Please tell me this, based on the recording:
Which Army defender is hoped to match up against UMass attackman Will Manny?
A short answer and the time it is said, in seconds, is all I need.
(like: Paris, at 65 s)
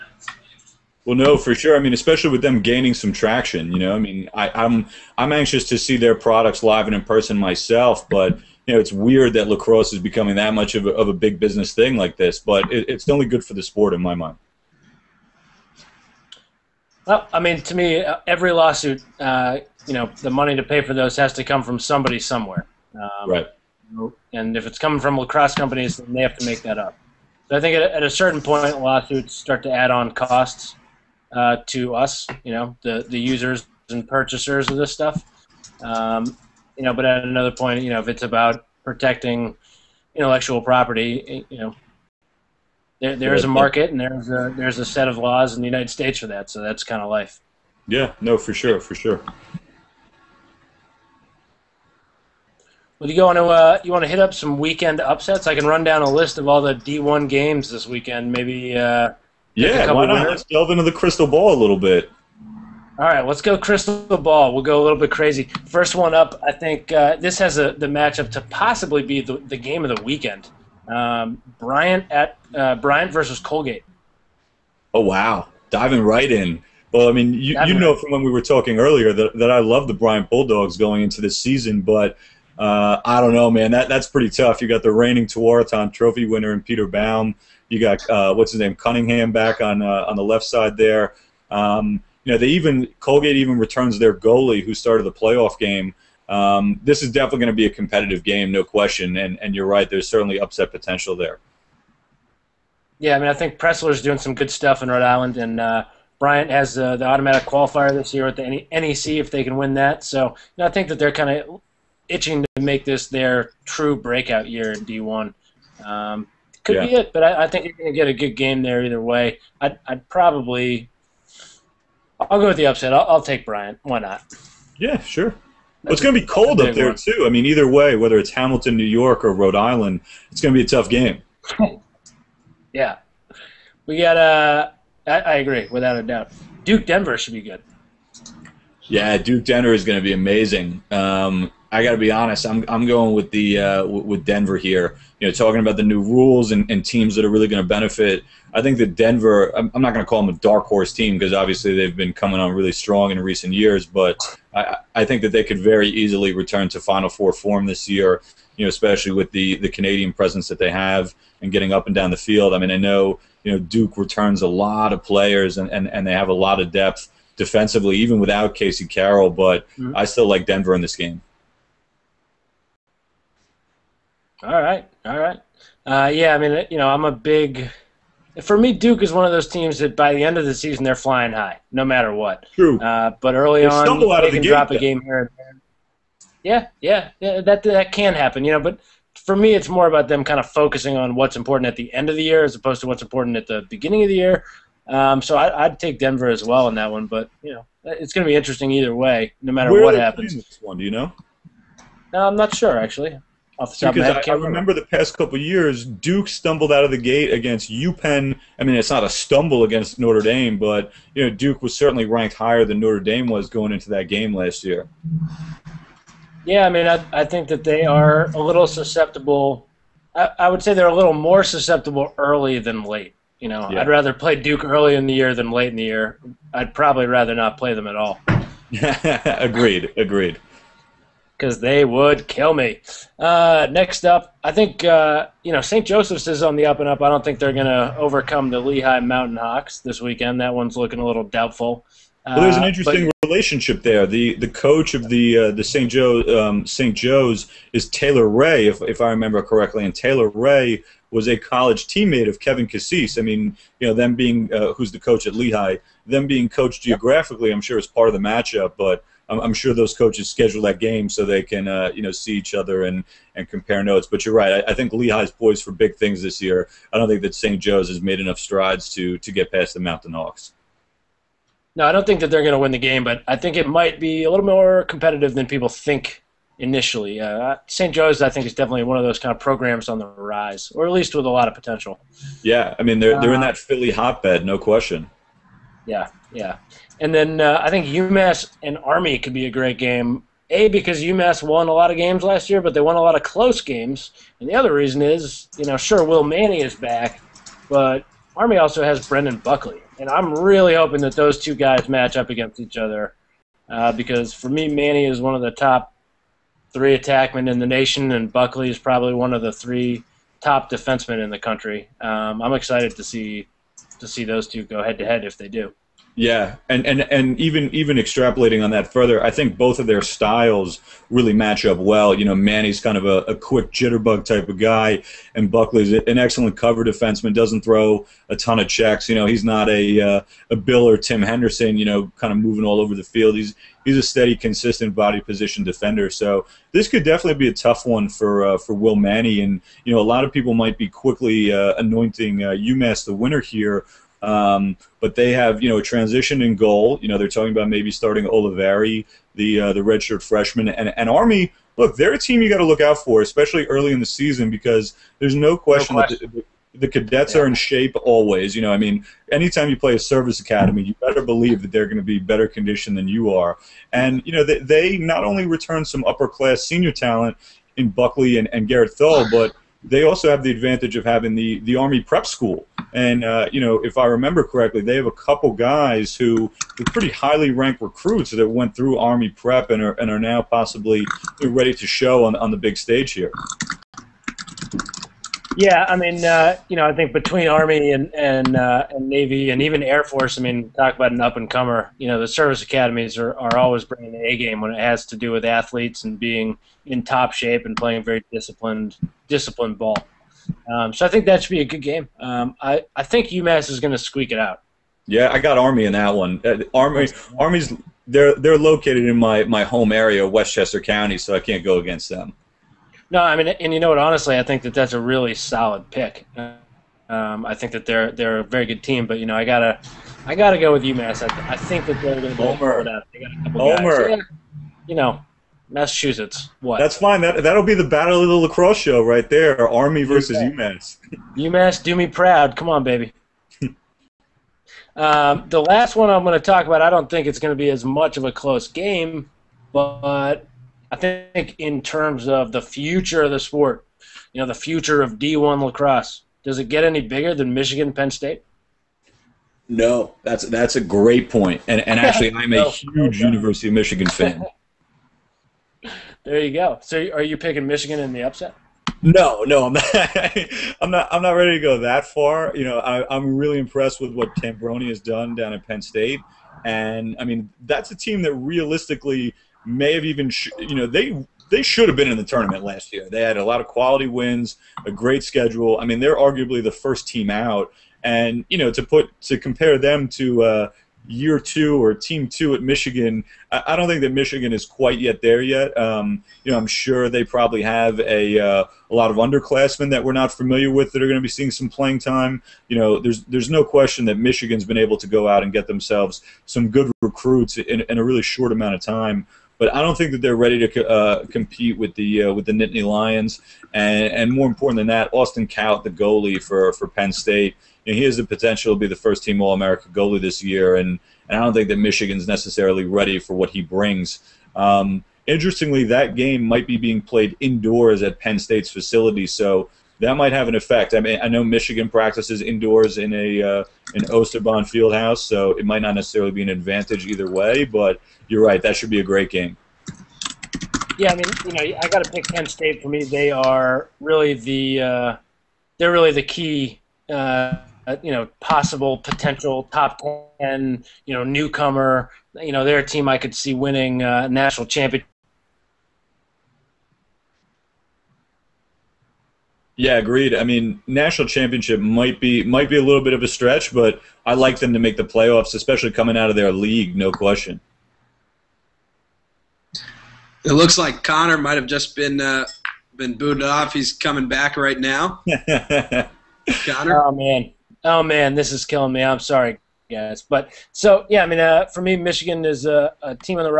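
Brendan Buckley, at 299 s.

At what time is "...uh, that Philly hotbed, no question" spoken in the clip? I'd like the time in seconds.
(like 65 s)
283 s.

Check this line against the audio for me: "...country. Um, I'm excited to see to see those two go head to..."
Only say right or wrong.
right.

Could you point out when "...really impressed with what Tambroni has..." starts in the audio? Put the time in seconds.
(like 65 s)
463 s.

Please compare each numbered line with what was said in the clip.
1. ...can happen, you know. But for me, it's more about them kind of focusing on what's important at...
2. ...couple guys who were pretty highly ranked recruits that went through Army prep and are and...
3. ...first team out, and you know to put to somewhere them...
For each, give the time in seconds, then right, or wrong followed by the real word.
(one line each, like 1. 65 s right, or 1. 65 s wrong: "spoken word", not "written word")
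1. 187 s right
2. 375 s right
3. 476 s wrong: "compare", not "somewhere".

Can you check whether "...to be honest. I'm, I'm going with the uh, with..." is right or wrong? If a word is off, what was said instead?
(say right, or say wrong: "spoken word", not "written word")
right.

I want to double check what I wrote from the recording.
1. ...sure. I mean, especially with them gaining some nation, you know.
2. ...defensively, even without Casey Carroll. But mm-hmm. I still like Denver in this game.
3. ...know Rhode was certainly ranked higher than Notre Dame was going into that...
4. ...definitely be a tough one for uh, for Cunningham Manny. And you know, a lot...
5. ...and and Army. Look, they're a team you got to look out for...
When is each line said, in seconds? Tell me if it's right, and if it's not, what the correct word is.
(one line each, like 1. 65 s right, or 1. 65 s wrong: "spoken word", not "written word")
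1. 1 s wrong: "traction", not "nation"
2. 167 s right
3. 211 s wrong: "Duke", not "Rhode"
4. 337 s wrong: "Will", not "Cunningham"
5. 350 s right.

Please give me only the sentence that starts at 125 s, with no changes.
Well, it's going to be cold up there one.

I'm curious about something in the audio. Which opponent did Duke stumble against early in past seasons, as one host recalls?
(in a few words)
UPenn.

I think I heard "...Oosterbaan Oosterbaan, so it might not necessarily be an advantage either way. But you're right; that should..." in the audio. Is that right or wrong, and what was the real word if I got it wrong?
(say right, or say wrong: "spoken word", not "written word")
wrong: "Fieldhouse", not "Oosterbaan".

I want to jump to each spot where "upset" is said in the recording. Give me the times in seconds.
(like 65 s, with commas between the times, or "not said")
55 s, 100 s, 122 s, 458 s.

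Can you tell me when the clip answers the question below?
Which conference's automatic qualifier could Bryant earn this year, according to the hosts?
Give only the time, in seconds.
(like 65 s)
108 s.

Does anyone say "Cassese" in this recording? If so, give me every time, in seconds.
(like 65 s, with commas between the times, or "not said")
252 s.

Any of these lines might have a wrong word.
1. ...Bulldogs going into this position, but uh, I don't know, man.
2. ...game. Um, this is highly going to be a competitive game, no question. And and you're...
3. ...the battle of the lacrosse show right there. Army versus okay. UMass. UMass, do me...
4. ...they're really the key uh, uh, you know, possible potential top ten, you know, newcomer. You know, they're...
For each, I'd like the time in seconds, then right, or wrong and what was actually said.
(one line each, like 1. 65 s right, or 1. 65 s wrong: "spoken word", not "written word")
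1. 80 s wrong: "season", not "position"
2. 95 s wrong: "definitely", not "highly"
3. 427 s right
4. 535 s right.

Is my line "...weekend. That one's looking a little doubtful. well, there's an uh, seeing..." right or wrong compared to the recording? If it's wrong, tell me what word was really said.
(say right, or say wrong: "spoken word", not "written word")
wrong: "interesting", not "seeing".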